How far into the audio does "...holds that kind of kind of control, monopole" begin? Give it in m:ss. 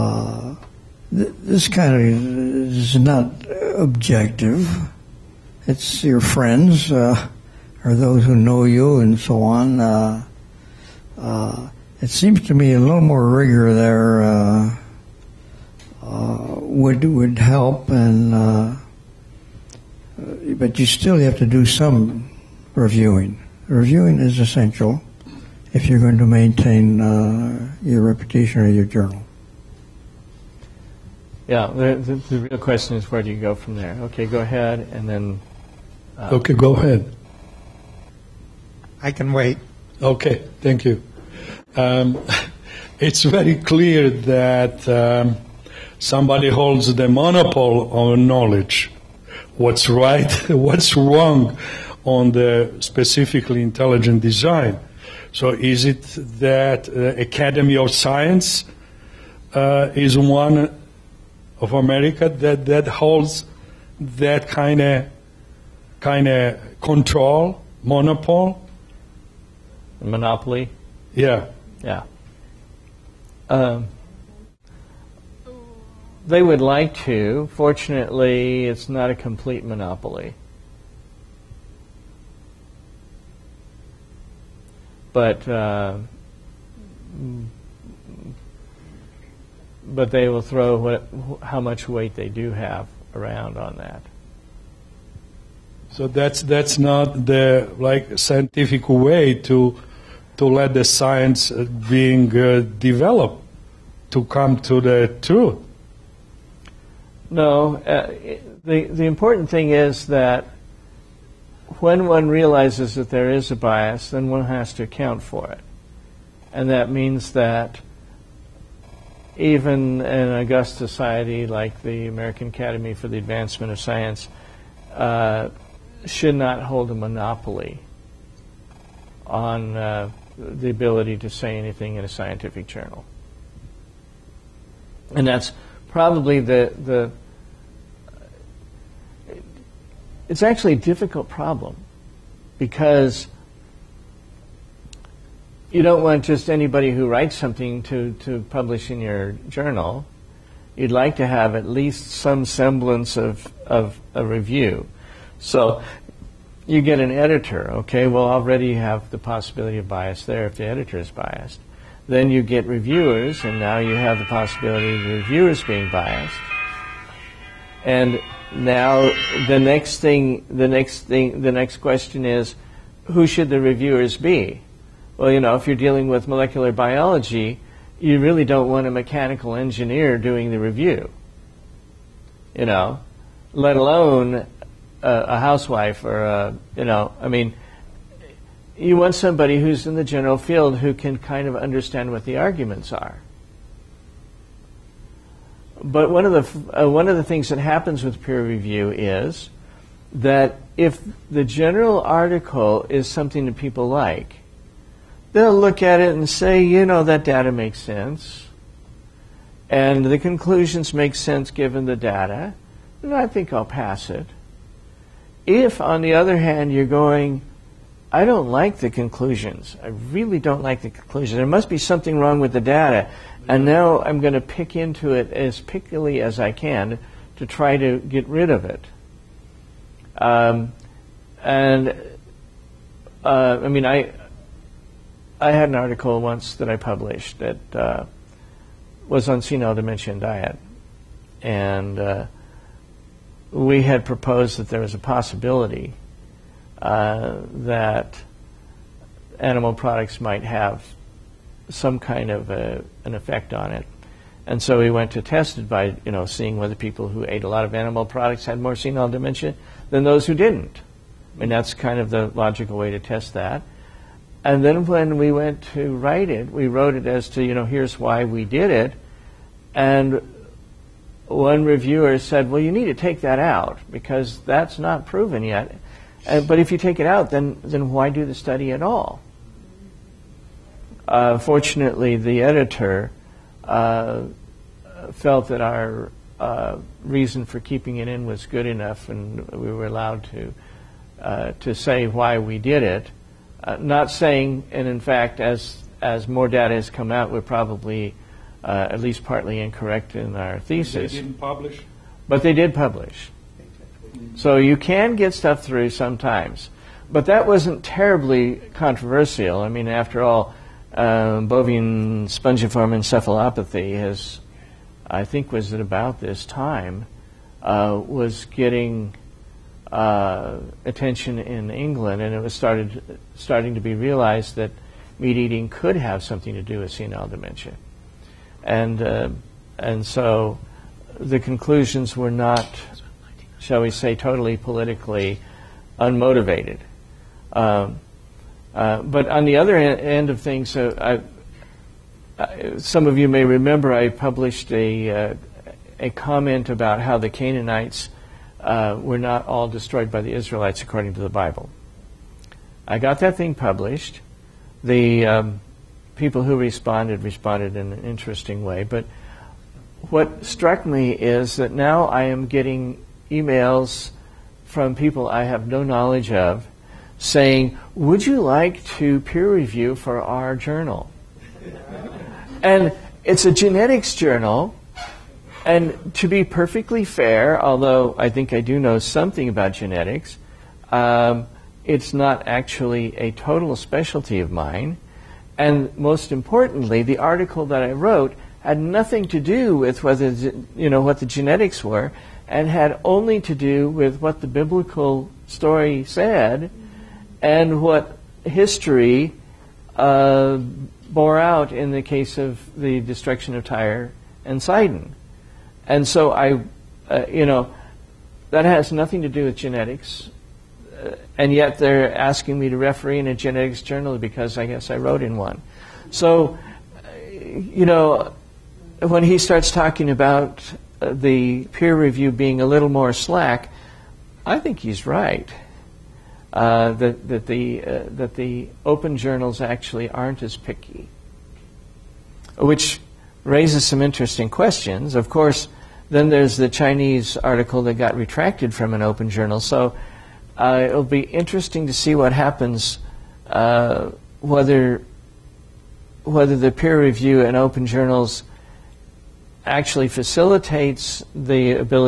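1:02.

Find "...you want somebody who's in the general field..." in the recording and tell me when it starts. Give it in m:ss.
3:08.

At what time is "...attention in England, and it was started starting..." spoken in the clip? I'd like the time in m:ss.
5:20.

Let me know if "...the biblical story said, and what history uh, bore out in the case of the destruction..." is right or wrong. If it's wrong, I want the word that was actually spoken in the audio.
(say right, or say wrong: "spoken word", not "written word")
right.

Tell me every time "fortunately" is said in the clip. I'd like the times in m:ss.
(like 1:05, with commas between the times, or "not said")
1:17, 4:41.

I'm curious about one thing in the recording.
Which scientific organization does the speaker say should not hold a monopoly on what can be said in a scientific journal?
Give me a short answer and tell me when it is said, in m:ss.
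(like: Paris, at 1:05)
American Academy for the Advancement of Science, at 2:02.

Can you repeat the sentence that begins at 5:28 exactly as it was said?
And, uh, and so the conclusions were not, shall we say, totally politically unmotivated.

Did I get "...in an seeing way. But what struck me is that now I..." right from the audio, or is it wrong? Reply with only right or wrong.
wrong.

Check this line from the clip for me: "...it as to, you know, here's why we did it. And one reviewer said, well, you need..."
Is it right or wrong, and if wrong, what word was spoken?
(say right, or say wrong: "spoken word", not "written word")
right.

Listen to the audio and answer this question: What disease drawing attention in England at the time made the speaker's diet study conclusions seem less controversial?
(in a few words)
bovine spongiform encephalopathy.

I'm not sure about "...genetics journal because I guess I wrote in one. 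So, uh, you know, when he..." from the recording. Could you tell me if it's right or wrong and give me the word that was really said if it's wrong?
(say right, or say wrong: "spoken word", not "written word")
right.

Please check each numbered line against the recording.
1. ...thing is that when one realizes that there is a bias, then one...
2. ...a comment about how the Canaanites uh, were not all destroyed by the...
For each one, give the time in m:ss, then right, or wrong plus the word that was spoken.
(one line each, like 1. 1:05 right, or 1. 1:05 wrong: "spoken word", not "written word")
1. 1:49 right
2. 5:45 right.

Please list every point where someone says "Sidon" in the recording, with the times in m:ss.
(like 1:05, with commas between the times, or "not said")
6:44.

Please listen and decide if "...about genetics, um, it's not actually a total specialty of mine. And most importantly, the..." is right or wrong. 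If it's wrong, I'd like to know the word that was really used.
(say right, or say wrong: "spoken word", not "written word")
right.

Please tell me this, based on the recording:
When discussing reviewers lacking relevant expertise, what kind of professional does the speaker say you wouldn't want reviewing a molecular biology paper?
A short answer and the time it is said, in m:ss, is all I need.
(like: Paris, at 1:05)
mechanical engineer, at 2:58.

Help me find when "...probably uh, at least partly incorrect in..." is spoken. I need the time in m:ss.
4:57.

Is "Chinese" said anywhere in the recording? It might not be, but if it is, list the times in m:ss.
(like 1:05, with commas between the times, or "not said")
7:16.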